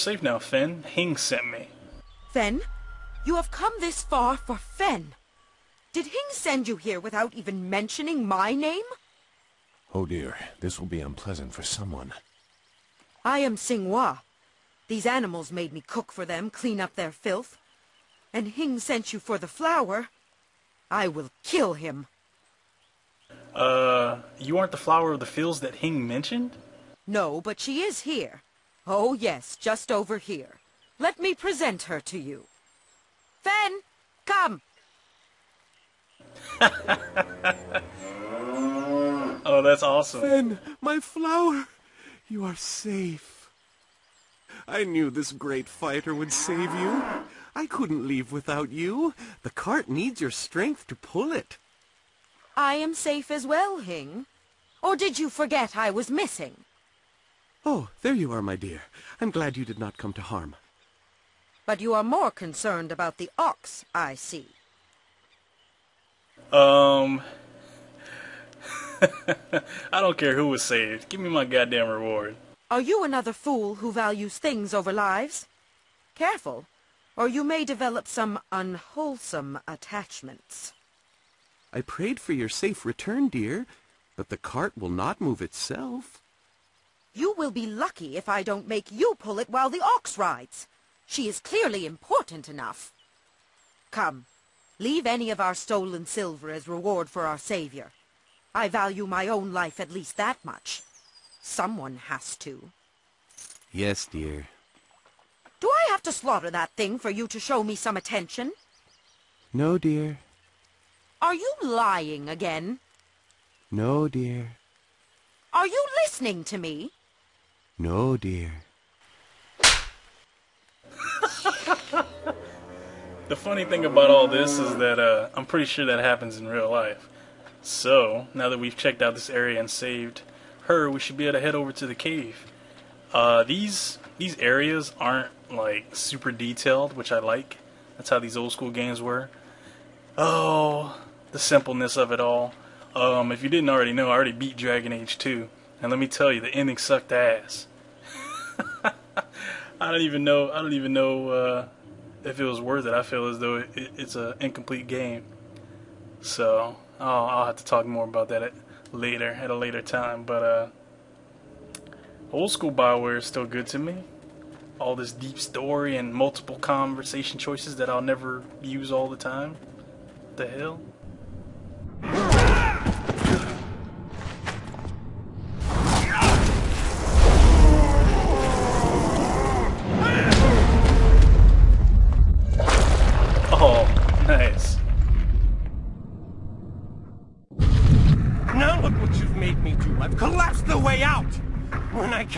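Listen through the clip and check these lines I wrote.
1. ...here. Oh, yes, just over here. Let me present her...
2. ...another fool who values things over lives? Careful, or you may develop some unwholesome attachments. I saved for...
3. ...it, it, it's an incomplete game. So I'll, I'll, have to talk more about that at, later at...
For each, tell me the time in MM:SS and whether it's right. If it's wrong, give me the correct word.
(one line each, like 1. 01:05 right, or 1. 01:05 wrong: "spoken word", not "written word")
1. 00:28 right
2. 01:13 wrong: "prayed", not "saved"
3. 02:33 right.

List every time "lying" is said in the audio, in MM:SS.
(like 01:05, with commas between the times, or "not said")
01:51.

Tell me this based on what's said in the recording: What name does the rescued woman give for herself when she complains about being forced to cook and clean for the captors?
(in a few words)
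Singhua.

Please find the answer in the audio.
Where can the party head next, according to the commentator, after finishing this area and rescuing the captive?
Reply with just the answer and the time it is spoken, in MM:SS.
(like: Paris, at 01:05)
the cave, at 02:11.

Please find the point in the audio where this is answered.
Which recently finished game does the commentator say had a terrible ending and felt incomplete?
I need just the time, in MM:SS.
02:24.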